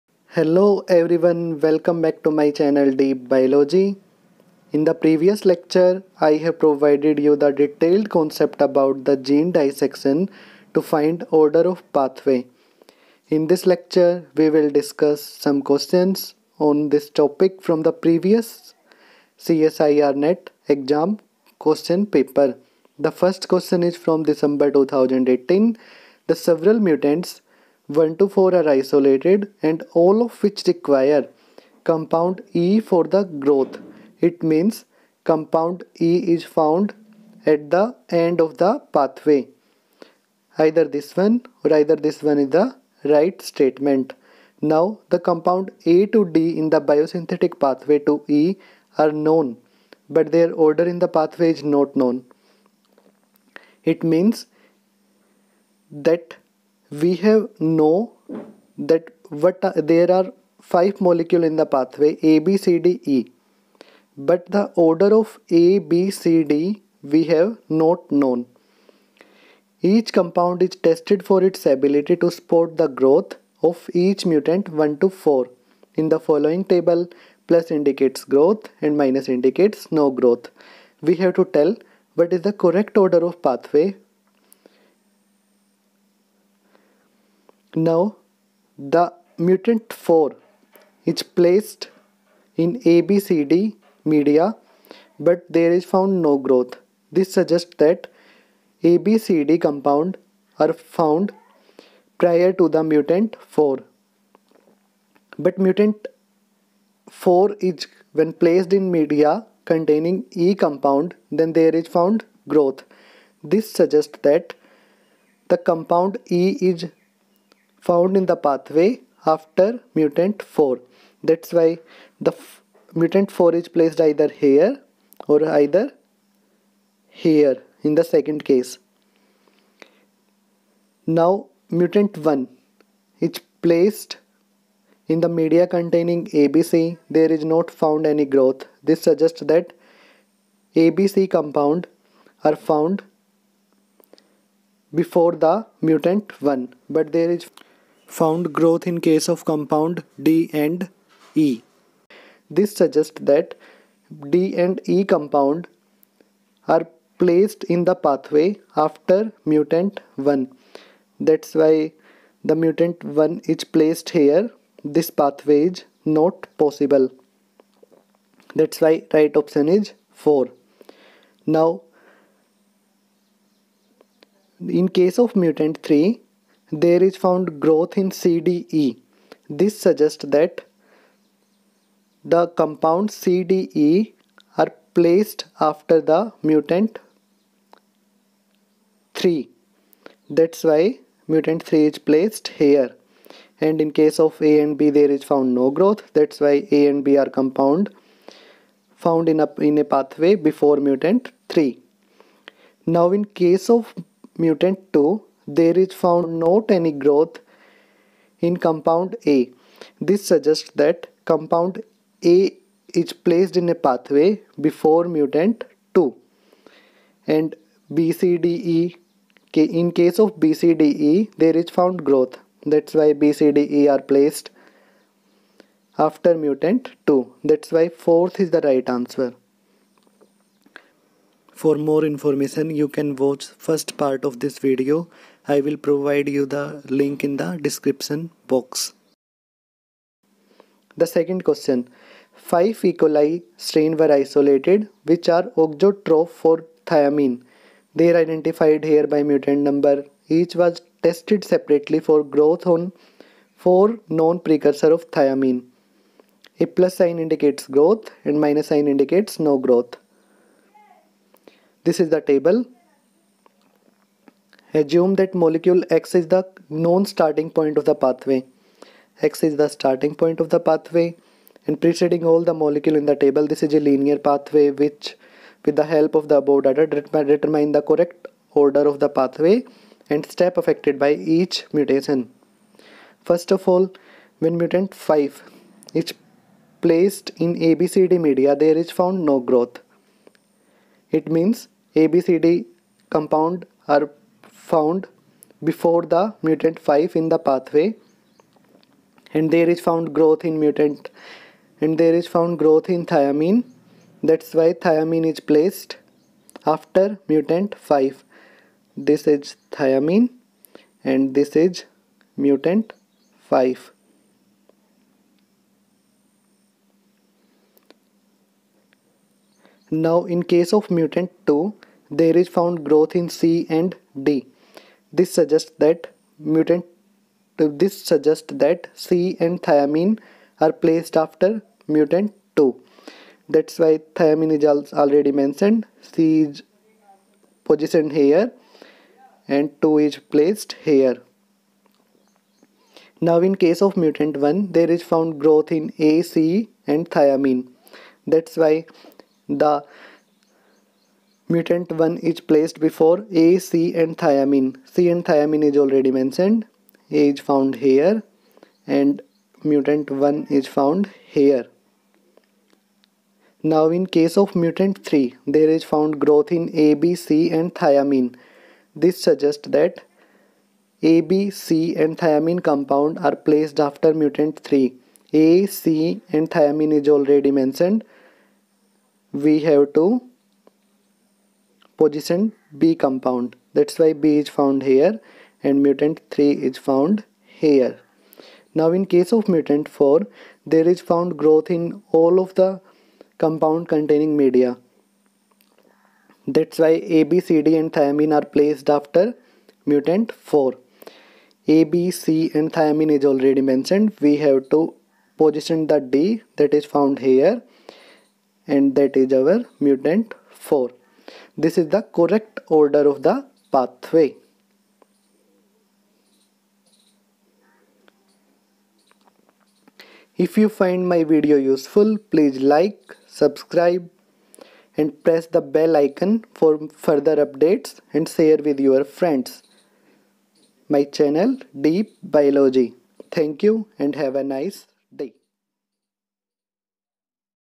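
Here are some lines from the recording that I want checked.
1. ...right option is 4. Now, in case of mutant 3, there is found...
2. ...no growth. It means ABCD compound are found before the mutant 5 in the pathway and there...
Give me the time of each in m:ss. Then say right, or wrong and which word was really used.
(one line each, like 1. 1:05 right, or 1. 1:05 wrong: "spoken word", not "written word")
1. 2:49 right
2. 4:49 right.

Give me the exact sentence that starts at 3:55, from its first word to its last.
I will provide you the link in the description box.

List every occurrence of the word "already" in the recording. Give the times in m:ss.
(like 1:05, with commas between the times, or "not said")
5:34, 5:55, 6:17, 6:43.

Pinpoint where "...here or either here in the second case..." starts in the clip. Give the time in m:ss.
2:04.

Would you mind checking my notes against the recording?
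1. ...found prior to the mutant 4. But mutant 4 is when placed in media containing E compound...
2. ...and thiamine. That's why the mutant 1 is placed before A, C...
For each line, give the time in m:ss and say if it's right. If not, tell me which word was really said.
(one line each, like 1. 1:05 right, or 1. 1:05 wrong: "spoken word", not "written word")
1. 1:40 right
2. 5:46 right.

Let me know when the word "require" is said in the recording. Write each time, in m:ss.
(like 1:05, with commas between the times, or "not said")
0:30.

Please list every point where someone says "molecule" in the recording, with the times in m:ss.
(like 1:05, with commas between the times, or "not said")
1:00, 4:25, 4:32.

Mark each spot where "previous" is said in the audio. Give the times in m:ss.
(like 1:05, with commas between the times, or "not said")
0:04, 0:17.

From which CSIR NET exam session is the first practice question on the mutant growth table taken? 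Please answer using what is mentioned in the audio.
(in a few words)
December 2018.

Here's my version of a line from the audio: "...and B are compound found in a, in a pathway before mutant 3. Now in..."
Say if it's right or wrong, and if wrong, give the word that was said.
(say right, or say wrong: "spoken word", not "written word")
right.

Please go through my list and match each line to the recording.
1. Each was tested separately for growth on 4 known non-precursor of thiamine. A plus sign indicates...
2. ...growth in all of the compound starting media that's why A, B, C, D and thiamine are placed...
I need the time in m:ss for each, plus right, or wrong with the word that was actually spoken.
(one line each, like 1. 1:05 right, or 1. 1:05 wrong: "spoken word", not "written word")
1. 4:10 right
2. 6:31 wrong: "containing", not "starting".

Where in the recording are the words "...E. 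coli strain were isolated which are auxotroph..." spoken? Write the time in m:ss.
4:02.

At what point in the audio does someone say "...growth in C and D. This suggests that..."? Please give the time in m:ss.
5:22.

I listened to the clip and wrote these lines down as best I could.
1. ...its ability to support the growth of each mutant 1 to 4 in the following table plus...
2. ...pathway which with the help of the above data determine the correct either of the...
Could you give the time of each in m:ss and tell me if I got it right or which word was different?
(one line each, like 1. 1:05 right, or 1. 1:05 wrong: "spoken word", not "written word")
1. 1:11 right
2. 4:34 wrong: "order", not "either".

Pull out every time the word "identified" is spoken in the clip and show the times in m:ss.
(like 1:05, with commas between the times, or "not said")
4:08.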